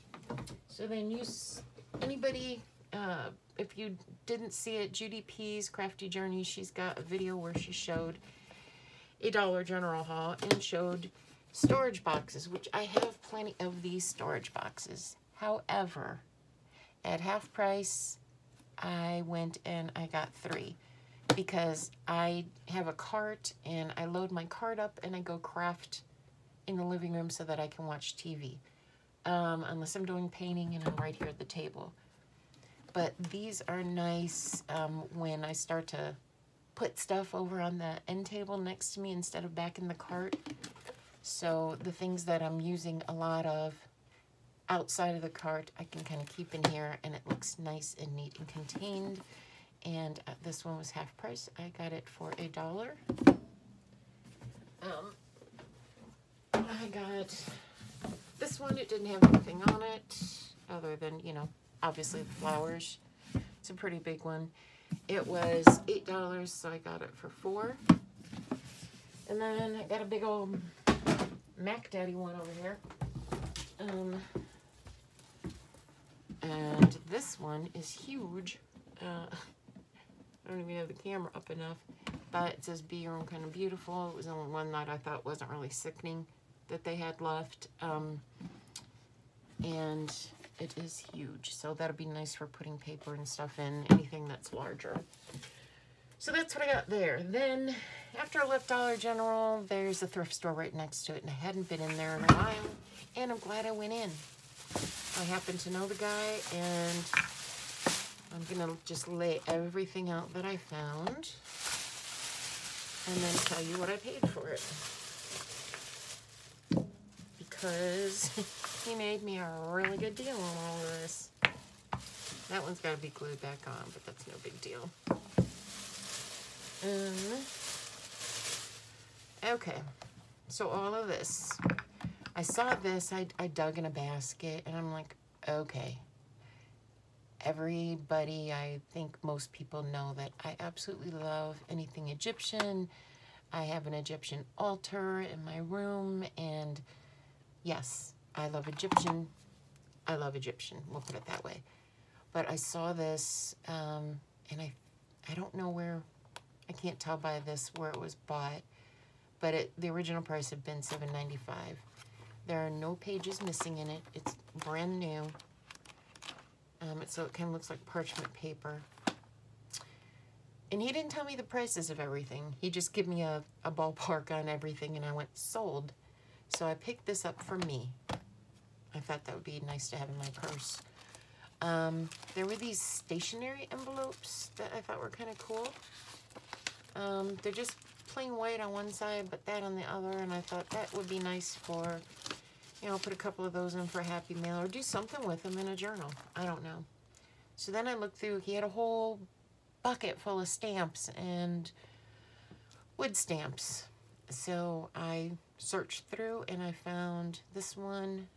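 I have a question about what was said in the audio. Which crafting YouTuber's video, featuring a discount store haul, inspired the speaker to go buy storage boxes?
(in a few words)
Judy P's Crafty Journey.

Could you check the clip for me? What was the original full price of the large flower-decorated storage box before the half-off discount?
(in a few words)
$8.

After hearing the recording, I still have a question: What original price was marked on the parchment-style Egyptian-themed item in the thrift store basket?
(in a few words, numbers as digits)
$7.95.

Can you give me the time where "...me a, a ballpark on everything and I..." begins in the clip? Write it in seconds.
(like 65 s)
173 s.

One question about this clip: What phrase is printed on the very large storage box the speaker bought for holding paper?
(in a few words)
Be Your Own Kind of Beautiful.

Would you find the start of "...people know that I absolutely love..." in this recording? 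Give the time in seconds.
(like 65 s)
139 s.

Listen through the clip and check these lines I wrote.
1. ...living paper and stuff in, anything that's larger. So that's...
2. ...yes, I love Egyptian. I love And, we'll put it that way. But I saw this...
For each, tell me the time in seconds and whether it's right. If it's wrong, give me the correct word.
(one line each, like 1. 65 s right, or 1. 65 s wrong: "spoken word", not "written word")
1. 92 s wrong: "putting", not "living"
2. 147 s wrong: "Egyptian", not "And".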